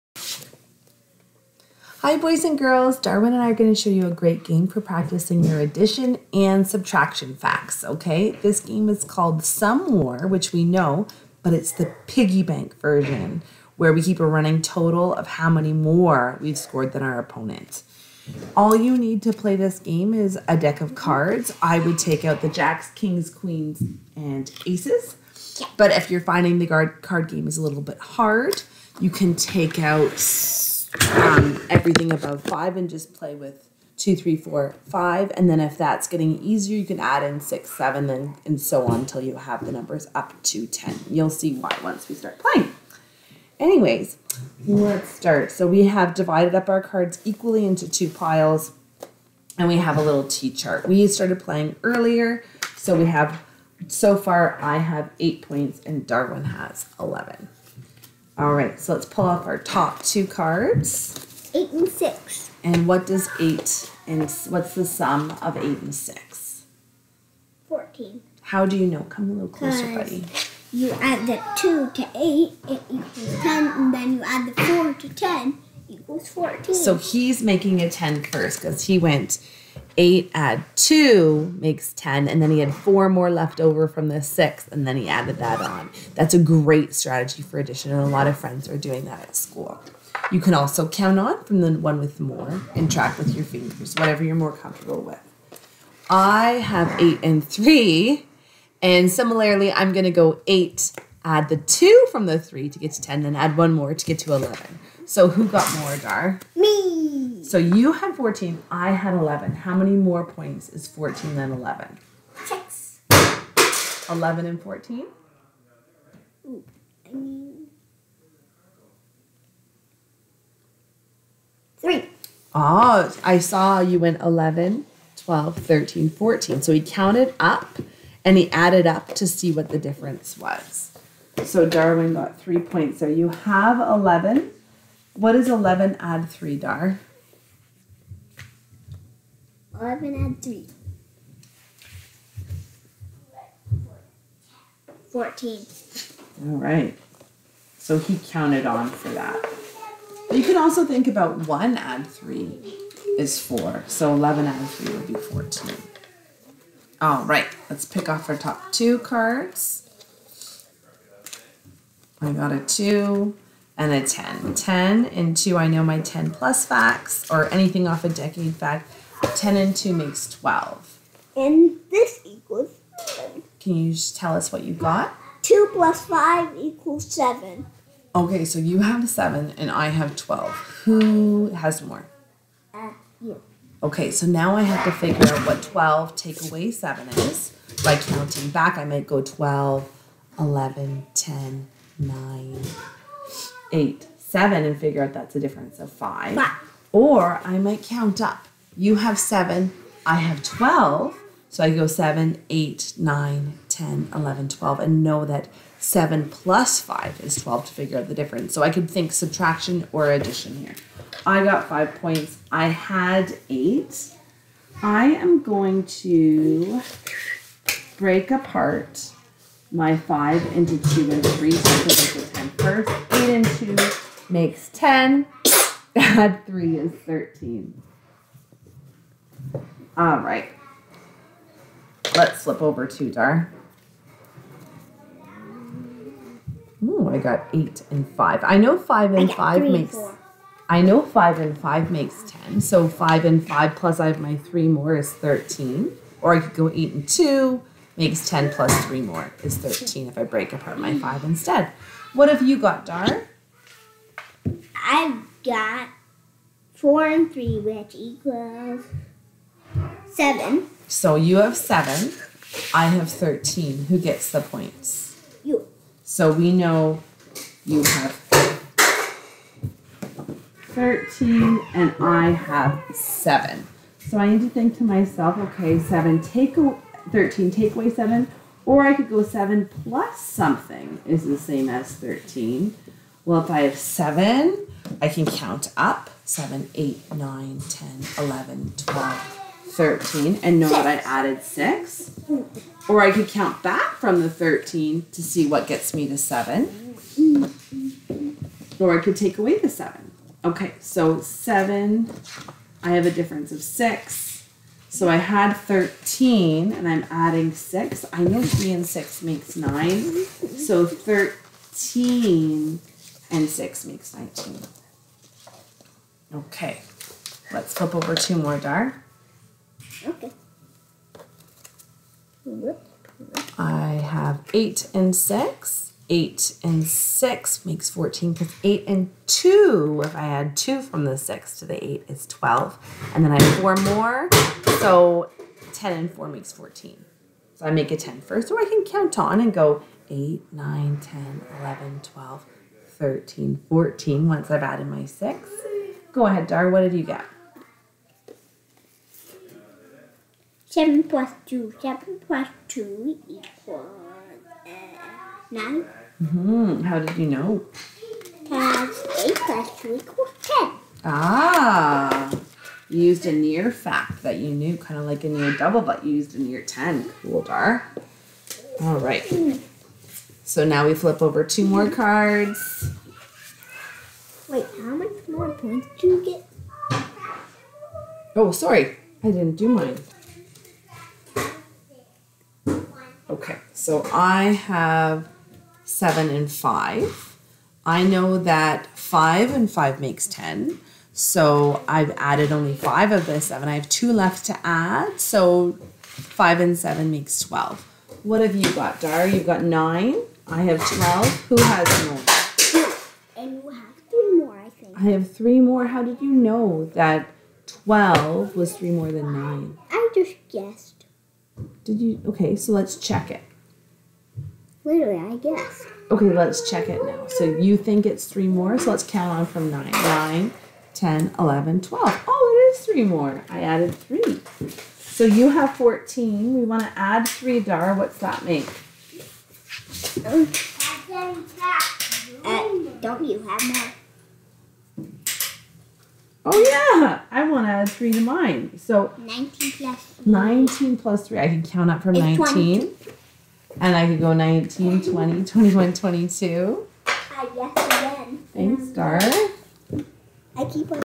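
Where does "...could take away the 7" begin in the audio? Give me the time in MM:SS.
04:59.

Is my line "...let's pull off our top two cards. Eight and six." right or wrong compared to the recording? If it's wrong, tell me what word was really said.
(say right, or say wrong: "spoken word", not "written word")
right.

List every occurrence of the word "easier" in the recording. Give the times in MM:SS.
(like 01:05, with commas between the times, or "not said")
00:36.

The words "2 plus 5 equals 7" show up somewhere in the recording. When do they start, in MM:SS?
02:55.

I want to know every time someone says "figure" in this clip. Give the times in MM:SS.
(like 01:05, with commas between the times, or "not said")
03:04, 03:14, 03:27.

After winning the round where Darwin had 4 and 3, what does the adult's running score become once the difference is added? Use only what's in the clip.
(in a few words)
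19.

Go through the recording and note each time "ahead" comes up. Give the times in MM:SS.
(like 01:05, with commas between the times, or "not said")
05:46.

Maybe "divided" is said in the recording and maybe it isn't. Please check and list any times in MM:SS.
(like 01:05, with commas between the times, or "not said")
00:46.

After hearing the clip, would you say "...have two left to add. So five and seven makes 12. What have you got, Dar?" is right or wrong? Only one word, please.
right.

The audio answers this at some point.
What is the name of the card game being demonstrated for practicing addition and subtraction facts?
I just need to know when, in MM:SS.
00:09.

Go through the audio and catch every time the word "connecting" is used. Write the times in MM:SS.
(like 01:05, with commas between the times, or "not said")
not said.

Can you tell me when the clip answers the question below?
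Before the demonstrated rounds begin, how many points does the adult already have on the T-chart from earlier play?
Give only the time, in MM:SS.
00:55.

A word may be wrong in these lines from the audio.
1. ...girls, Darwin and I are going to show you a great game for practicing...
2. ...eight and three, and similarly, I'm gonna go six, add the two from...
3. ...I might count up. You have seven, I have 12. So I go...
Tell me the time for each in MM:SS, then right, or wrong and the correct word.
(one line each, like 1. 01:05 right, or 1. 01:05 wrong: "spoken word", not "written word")
1. 00:02 right
2. 01:37 wrong: "eight", not "six"
3. 03:17 right.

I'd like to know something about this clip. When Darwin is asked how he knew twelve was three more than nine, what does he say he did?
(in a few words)
guessed.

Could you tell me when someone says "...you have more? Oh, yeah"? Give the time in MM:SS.
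07:13.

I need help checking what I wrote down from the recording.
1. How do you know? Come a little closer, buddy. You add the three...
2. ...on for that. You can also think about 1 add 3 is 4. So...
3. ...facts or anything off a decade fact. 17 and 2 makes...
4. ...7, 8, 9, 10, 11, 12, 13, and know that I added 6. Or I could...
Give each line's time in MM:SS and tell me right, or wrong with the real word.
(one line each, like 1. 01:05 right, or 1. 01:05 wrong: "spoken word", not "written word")
1. 01:08 wrong: "two", not "three"
2. 02:28 right
3. 02:46 wrong: "10", not "17"
4. 04:46 right.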